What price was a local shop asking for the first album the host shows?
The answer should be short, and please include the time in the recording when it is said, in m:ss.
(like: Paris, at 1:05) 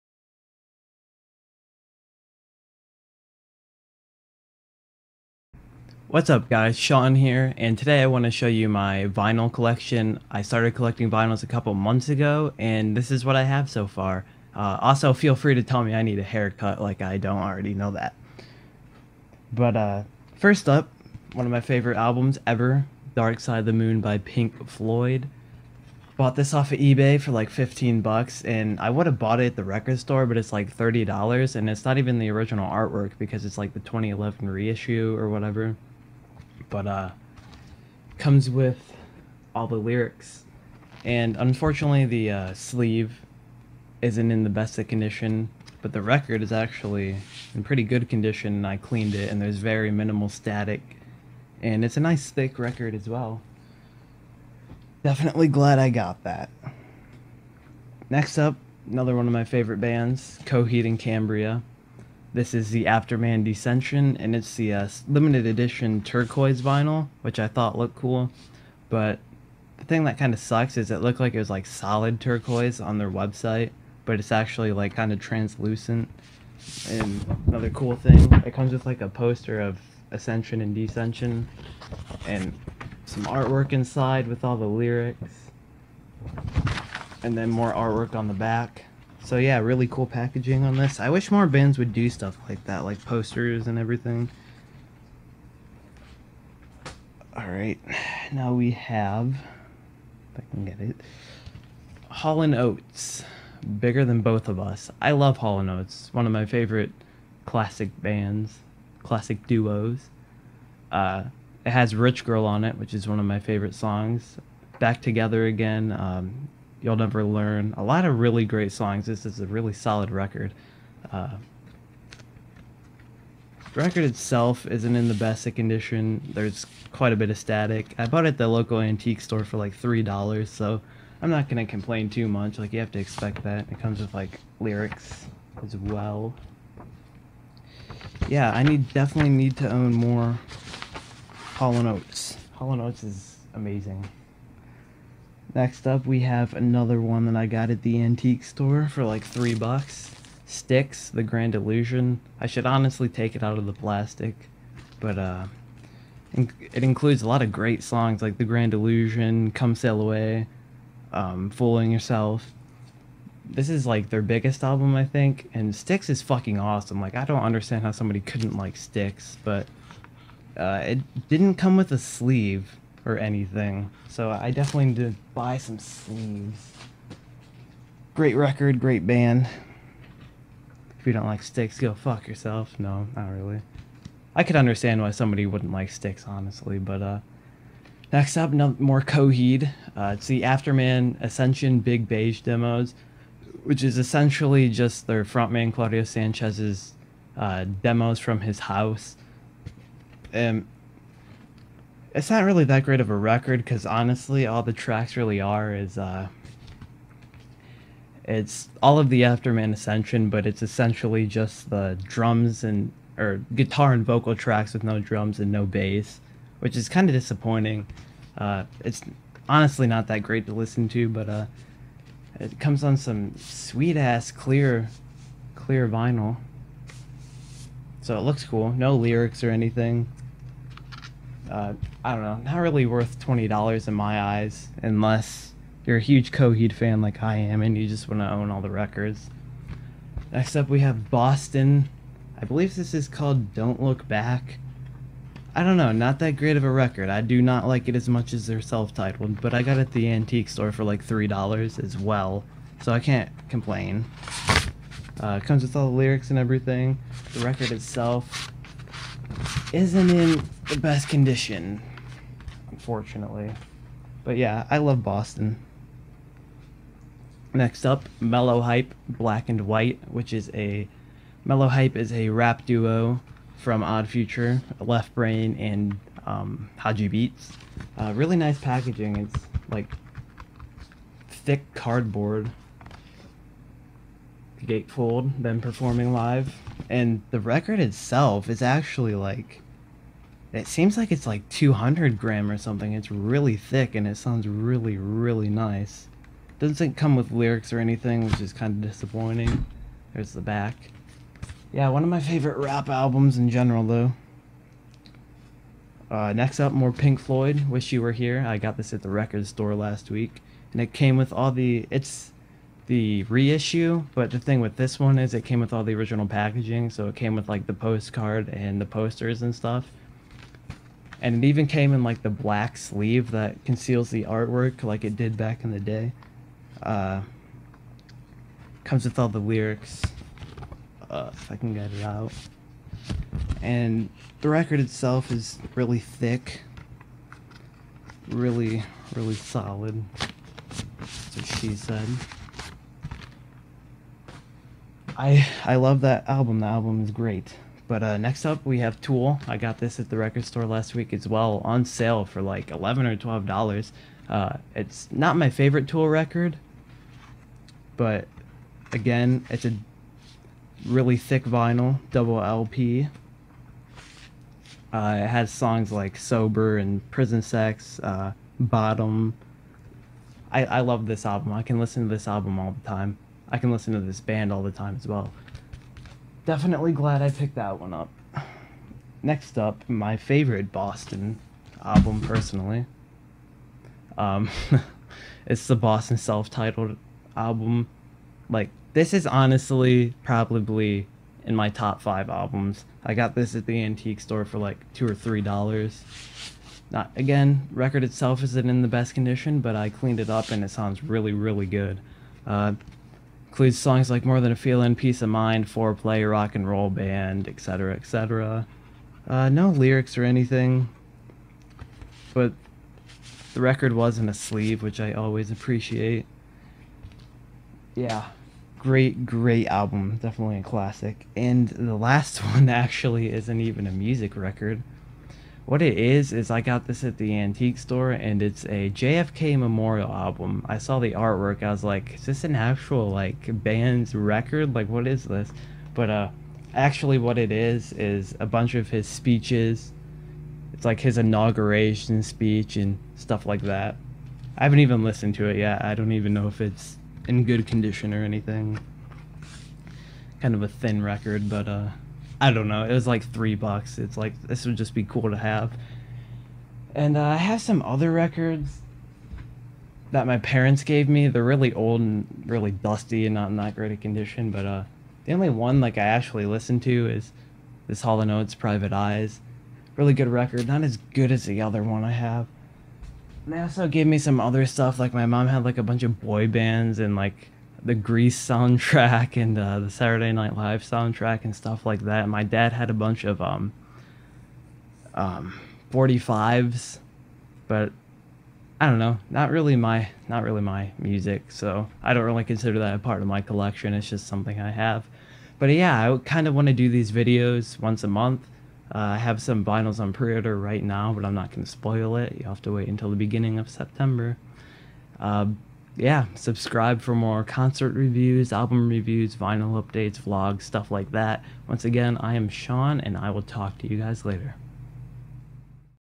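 $30, at 0:30.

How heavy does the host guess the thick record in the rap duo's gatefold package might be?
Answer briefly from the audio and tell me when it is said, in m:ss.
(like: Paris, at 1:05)
200 gram, at 4:51.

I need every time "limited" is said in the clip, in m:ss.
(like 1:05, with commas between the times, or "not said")
1:05.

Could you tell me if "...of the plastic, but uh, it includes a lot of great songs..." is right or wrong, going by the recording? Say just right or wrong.
right.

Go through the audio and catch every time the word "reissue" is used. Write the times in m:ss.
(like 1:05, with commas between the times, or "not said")
0:34, 5:13.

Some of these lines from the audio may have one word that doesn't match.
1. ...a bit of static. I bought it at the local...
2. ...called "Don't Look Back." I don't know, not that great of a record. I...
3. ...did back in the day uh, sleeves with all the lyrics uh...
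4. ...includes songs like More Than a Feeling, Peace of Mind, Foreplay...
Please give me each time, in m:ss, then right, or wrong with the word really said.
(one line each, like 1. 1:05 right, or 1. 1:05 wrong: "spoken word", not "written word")
1. 2:07 right
2. 4:03 right
3. 5:25 wrong: "comes", not "sleeves"
4. 6:43 right.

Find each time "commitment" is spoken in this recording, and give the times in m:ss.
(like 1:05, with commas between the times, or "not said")
not said.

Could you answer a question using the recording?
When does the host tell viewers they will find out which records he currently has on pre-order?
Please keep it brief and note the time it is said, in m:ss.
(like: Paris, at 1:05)
beginning of September, at 8:23.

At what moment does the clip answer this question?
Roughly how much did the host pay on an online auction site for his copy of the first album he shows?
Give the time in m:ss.
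0:27.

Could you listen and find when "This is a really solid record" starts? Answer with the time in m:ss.
1:59.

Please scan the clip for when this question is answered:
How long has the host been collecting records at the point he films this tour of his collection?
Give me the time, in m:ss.
0:11.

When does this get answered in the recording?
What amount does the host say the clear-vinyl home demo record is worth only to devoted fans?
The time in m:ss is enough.
3:53.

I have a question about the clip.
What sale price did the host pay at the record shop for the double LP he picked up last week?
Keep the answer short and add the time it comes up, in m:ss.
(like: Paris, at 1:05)
$11 or $12, at 5:52.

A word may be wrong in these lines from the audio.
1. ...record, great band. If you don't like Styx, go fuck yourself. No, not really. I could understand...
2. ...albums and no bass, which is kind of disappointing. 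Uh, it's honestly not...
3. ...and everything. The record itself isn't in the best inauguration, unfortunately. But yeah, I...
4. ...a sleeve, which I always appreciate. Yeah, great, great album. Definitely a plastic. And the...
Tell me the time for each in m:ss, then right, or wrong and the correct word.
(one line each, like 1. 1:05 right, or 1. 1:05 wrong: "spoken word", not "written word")
1. 2:58 right
2. 3:34 wrong: "drums", not "albums"
3. 4:16 wrong: "condition", not "inauguration"
4. 6:54 wrong: "classic", not "plastic".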